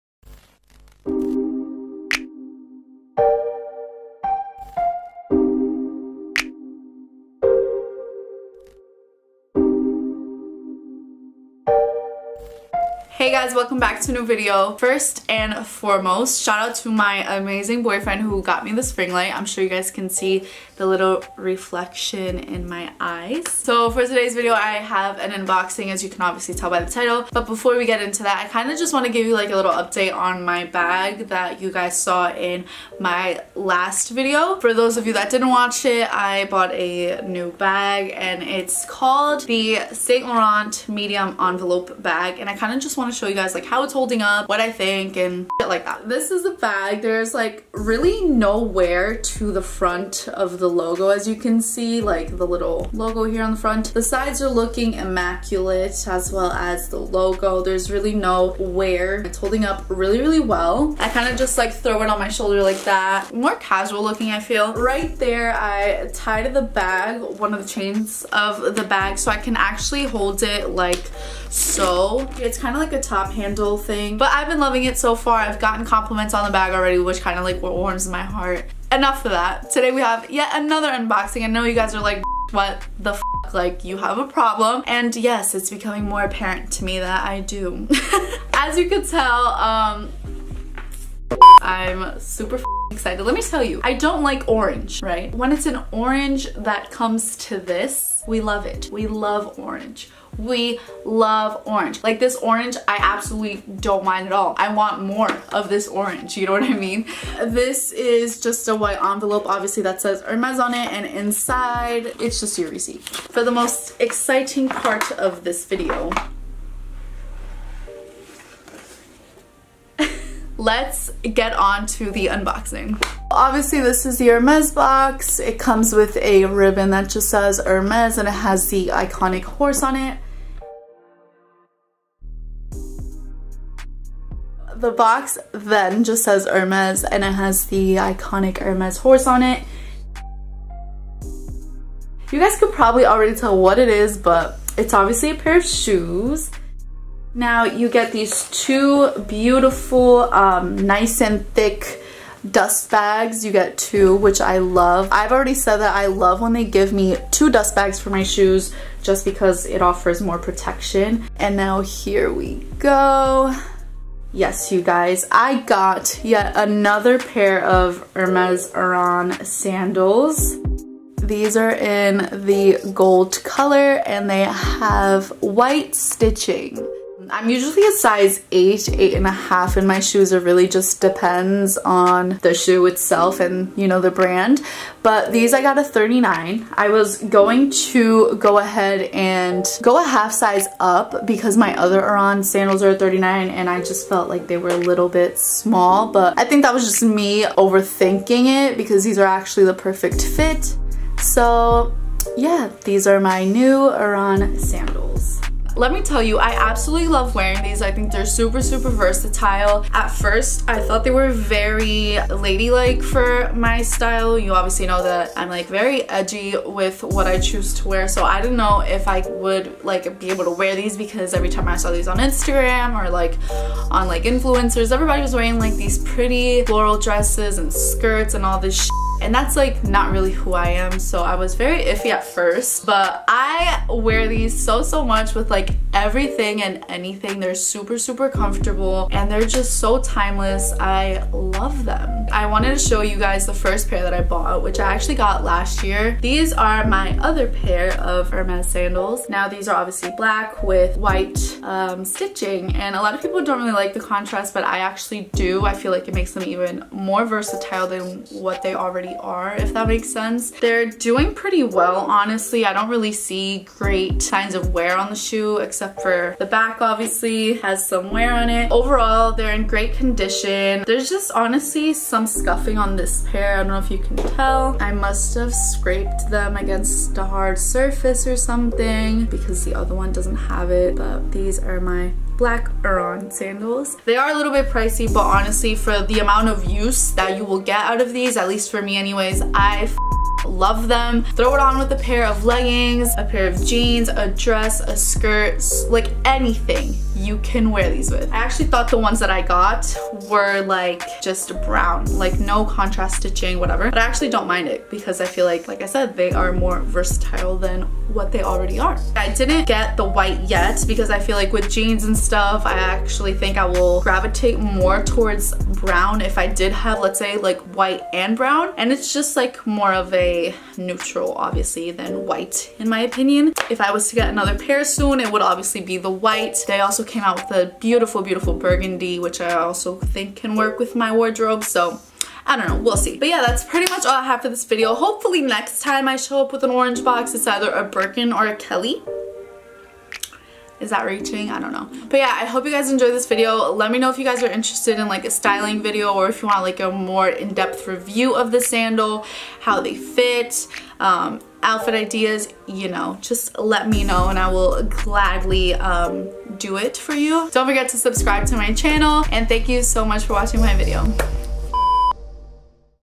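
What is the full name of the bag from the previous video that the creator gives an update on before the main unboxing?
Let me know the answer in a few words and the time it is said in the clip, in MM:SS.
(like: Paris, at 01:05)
Saint Laurent Medium Envelope Bag, at 00:39.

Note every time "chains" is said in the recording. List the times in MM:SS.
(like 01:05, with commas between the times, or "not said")
01:07.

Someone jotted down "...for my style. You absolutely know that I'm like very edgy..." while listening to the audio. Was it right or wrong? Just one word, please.
wrong.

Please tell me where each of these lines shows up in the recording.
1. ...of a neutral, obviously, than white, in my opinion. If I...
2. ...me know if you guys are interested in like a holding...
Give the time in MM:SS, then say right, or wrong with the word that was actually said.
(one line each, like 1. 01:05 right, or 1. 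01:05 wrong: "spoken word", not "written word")
1. 05:19 right
2. 05:43 wrong: "styling", not "holding".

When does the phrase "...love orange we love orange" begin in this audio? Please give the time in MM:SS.
01:39.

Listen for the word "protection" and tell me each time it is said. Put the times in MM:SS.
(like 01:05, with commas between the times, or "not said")
02:40.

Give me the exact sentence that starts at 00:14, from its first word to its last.
First and foremost, shout out to my amazing boyfriend who got me this ring light.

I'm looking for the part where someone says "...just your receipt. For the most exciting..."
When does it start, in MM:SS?
01:52.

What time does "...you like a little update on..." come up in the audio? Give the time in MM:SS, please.
00:29.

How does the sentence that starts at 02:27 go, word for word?
Now you get these two beautiful, um, nice and thick dust bags.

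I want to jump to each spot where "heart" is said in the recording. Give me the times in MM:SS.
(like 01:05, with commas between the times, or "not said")
01:18.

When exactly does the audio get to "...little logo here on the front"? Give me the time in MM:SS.
00:52.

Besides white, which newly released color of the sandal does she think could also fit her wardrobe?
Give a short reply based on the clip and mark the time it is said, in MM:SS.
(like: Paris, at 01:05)
Burgundy, at 05:28.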